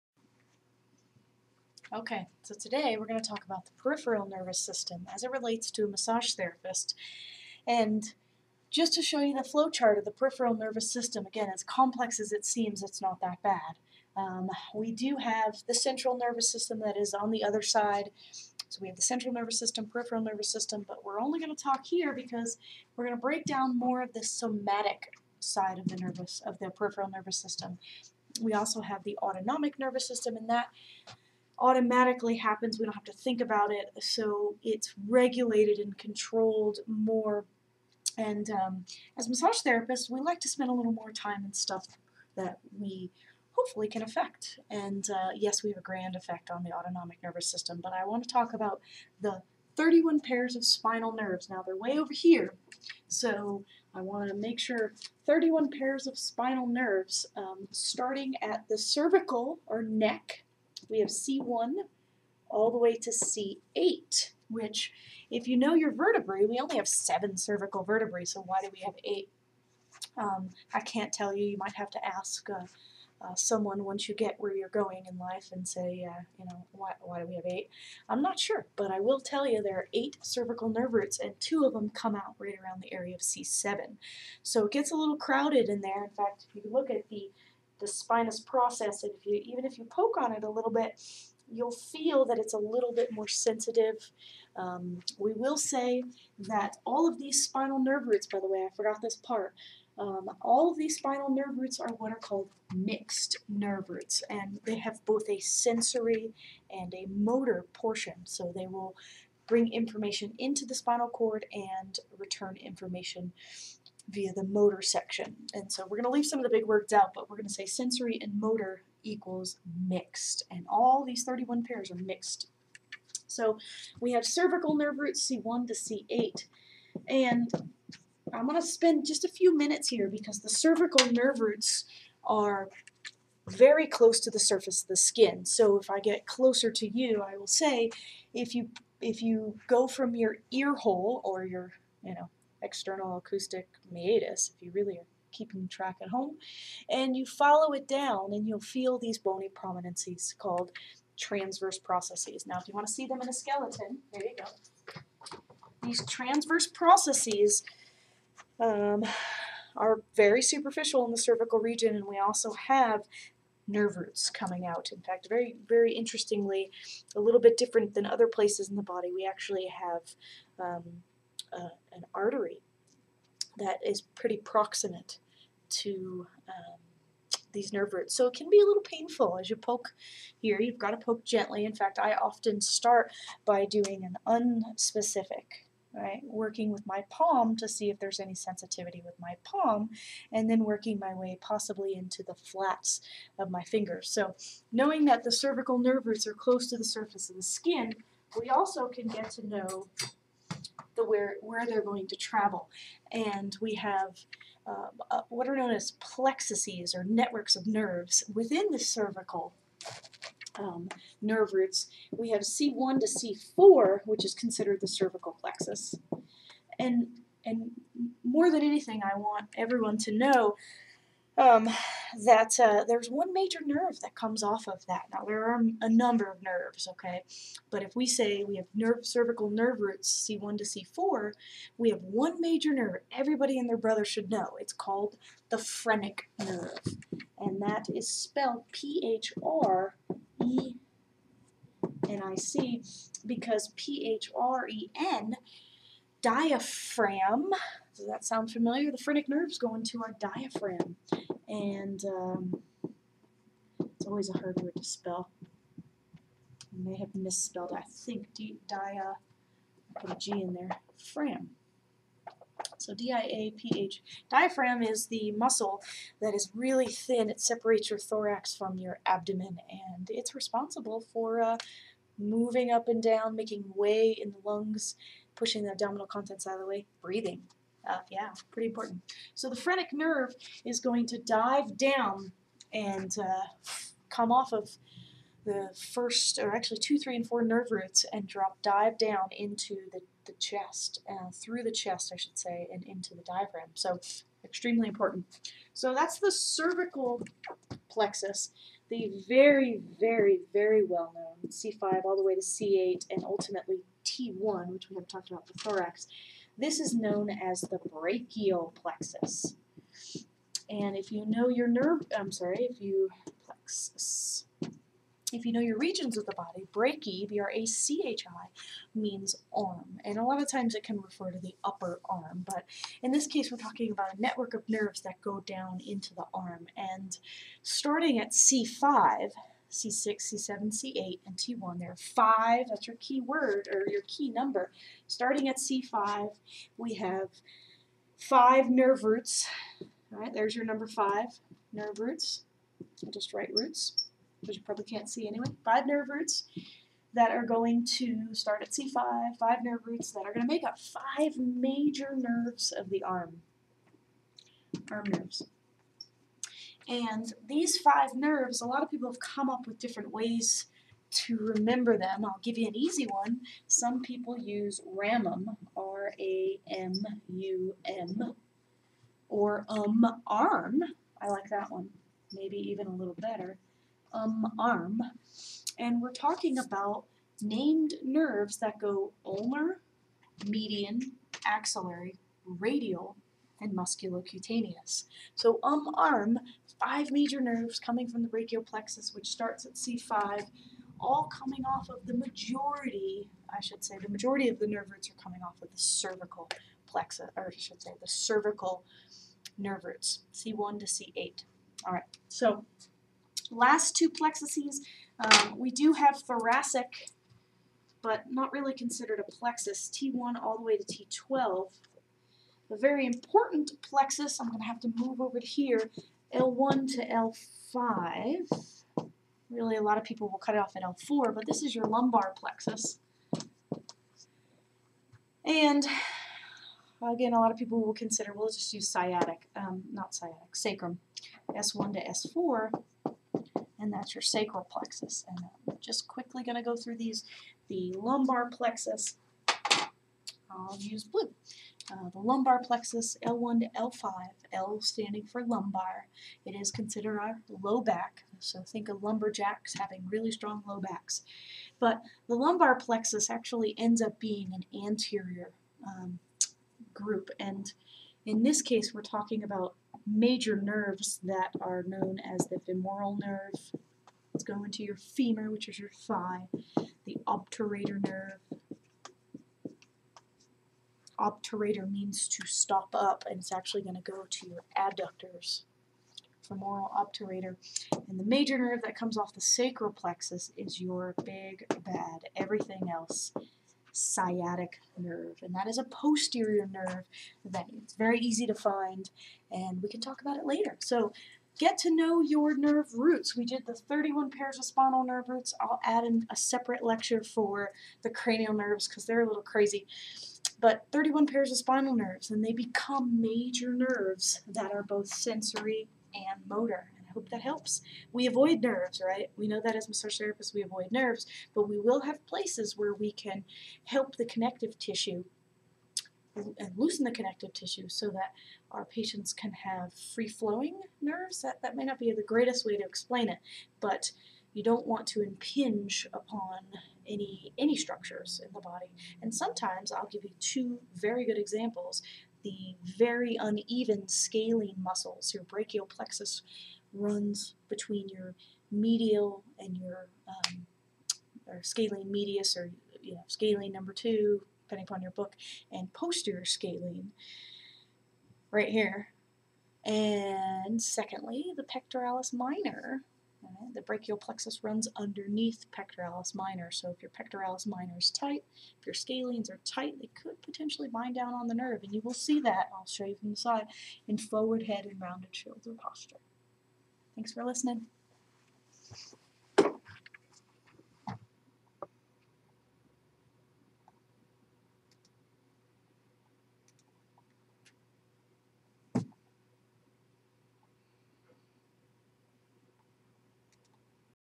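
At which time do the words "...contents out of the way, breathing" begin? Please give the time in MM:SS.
04:36.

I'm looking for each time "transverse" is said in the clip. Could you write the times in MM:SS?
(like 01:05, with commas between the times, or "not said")
02:31, 02:36.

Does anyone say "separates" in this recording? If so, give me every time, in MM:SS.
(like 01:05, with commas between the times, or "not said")
04:27, 08:16.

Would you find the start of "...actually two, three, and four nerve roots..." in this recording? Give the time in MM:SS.
04:46.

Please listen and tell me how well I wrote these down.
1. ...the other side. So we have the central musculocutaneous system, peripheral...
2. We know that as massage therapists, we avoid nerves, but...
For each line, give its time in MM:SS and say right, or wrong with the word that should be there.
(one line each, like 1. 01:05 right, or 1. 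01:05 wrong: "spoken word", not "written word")
1. 00:17 wrong: "nervous", not "musculocutaneous"
2. 08:29 right.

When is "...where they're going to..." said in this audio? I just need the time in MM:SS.
03:21.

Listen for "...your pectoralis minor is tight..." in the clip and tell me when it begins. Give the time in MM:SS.
09:17.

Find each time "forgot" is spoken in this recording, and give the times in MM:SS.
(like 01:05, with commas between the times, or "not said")
01:38.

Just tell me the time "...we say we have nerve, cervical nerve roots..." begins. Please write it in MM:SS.
03:47.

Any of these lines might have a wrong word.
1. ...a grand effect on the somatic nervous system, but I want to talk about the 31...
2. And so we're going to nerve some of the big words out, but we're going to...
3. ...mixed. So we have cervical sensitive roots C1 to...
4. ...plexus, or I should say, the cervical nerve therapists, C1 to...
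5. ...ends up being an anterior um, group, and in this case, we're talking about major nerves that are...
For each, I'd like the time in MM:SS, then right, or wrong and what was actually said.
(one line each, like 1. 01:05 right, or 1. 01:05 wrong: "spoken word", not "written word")
1. 00:45 wrong: "autonomic", not "somatic"
2. 01:55 wrong: "leave", not "nerve"
3. 02:01 wrong: "nerve", not "sensitive"
4. 06:36 wrong: "roots", not "therapists"
5. 07:33 right.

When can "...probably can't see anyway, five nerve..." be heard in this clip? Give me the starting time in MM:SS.
05:44.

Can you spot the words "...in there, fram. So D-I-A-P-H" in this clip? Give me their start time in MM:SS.
04:20.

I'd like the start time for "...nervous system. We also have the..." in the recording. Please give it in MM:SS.
00:27.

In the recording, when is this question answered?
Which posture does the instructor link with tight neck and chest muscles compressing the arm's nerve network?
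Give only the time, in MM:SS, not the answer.
09:24.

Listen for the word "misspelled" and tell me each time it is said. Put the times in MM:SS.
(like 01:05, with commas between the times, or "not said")
04:17.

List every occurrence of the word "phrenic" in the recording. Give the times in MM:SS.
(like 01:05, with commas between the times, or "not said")
03:55, 04:08, 04:39.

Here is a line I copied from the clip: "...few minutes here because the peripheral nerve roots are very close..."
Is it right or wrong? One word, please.
wrong.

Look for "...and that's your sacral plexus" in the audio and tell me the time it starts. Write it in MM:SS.
07:13.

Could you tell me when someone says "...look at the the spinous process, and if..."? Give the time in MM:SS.
01:26.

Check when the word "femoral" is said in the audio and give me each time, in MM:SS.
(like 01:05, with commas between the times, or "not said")
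07:42, 07:56.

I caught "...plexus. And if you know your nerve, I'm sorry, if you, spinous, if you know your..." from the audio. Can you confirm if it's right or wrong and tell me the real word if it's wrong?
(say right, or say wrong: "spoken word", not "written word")
wrong: "plexus", not "spinous".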